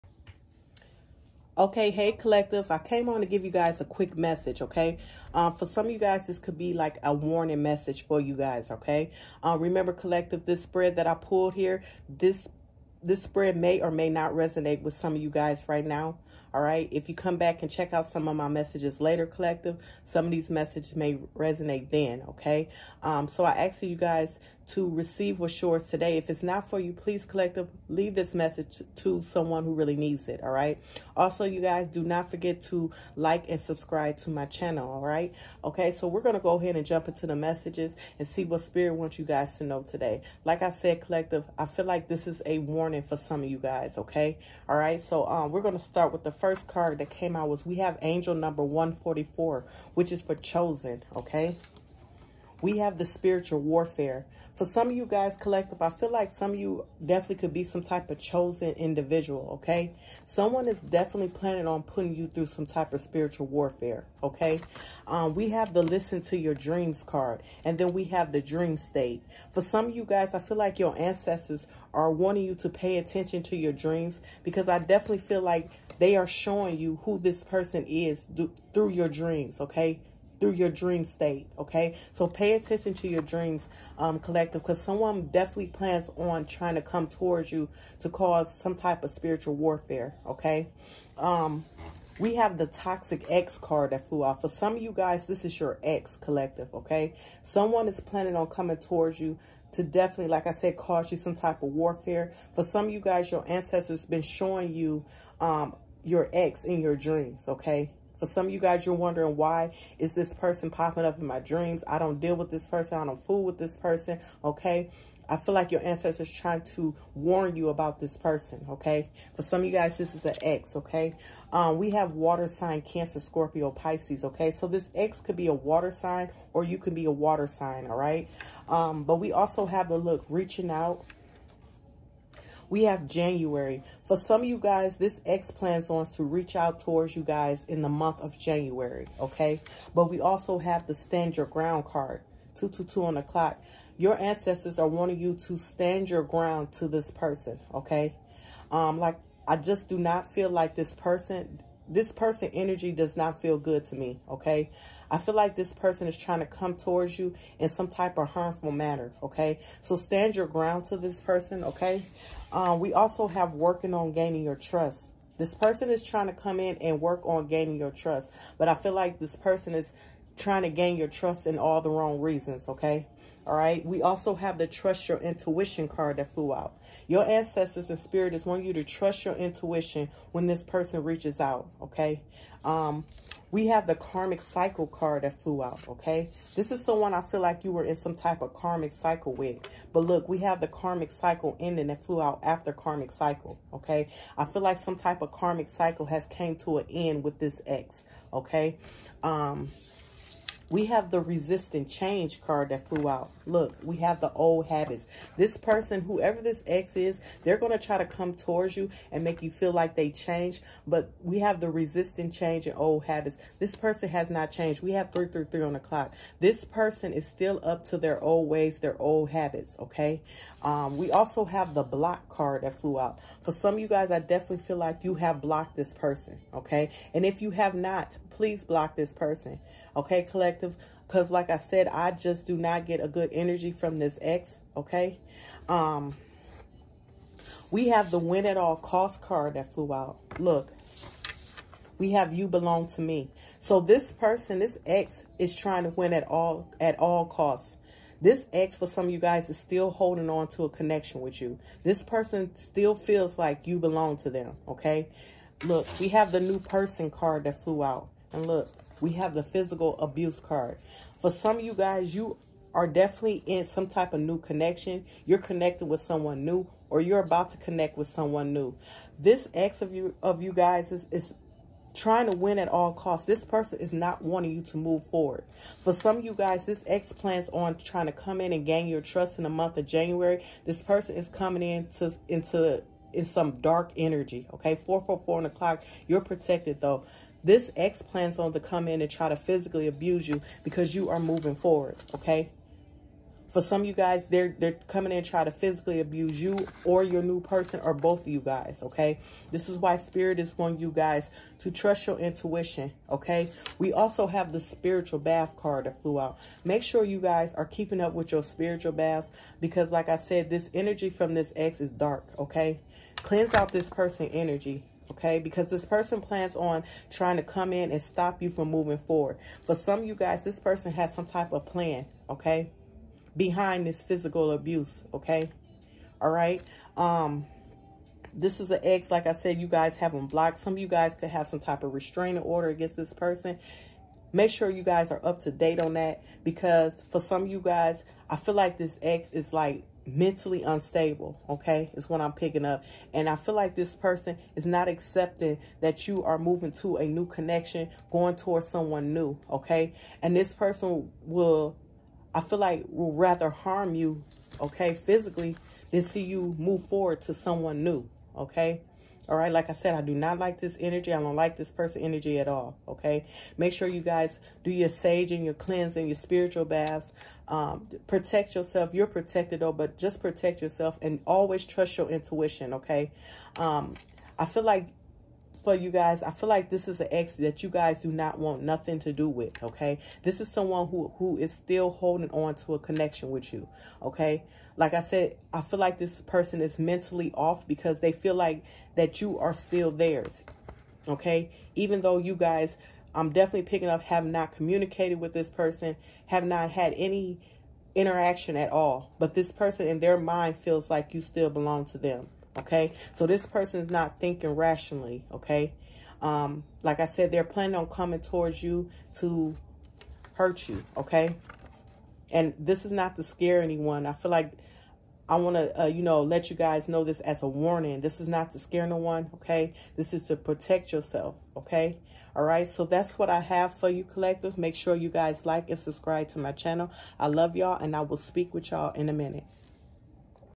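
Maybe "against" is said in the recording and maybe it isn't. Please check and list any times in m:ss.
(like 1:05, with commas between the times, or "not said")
5:32.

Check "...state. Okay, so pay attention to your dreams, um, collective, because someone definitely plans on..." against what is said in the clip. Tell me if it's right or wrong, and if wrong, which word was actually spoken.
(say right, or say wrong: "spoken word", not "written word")
right.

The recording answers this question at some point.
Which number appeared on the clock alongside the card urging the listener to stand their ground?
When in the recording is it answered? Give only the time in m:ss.
2:22.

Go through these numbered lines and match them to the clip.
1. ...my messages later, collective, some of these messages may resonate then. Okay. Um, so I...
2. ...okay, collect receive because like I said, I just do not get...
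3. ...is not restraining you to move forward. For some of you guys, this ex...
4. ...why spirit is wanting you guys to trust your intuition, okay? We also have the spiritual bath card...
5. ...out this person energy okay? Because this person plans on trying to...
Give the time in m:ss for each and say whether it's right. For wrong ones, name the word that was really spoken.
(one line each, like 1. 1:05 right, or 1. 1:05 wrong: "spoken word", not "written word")
1. 0:18 right
2. 3:49 wrong: "perspective", not "receive"
3. 4:33 wrong: "wanting", not "restraining"
4. 4:59 right
5. 5:13 right.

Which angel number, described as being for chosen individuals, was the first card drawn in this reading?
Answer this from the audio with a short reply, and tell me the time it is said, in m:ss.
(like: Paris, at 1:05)
144, at 0:48.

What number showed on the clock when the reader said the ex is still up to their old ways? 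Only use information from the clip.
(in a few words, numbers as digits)
333.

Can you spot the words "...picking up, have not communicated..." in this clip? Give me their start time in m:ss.
6:33.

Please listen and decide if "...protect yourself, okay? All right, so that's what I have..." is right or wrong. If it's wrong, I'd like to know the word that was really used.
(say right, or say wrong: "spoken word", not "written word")
right.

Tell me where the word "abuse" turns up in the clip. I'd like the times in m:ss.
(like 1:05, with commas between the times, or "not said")
4:19, 4:49, 4:55, 5:24.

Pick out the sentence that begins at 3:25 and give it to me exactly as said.
This person, whoever this ex is, they're going to try to come towards you and make you feel like they changed.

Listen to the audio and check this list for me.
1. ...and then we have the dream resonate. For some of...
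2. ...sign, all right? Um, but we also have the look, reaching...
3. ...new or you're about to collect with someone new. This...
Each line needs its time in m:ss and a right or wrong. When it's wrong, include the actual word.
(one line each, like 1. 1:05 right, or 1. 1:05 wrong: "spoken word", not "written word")
1. 1:07 wrong: "state", not "resonate"
2. 2:07 right
3. 4:26 wrong: "connect", not "collect".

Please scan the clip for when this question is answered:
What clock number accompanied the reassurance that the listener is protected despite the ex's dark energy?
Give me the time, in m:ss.
4:44.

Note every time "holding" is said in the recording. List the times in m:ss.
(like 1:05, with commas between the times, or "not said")
4:09, 6:21.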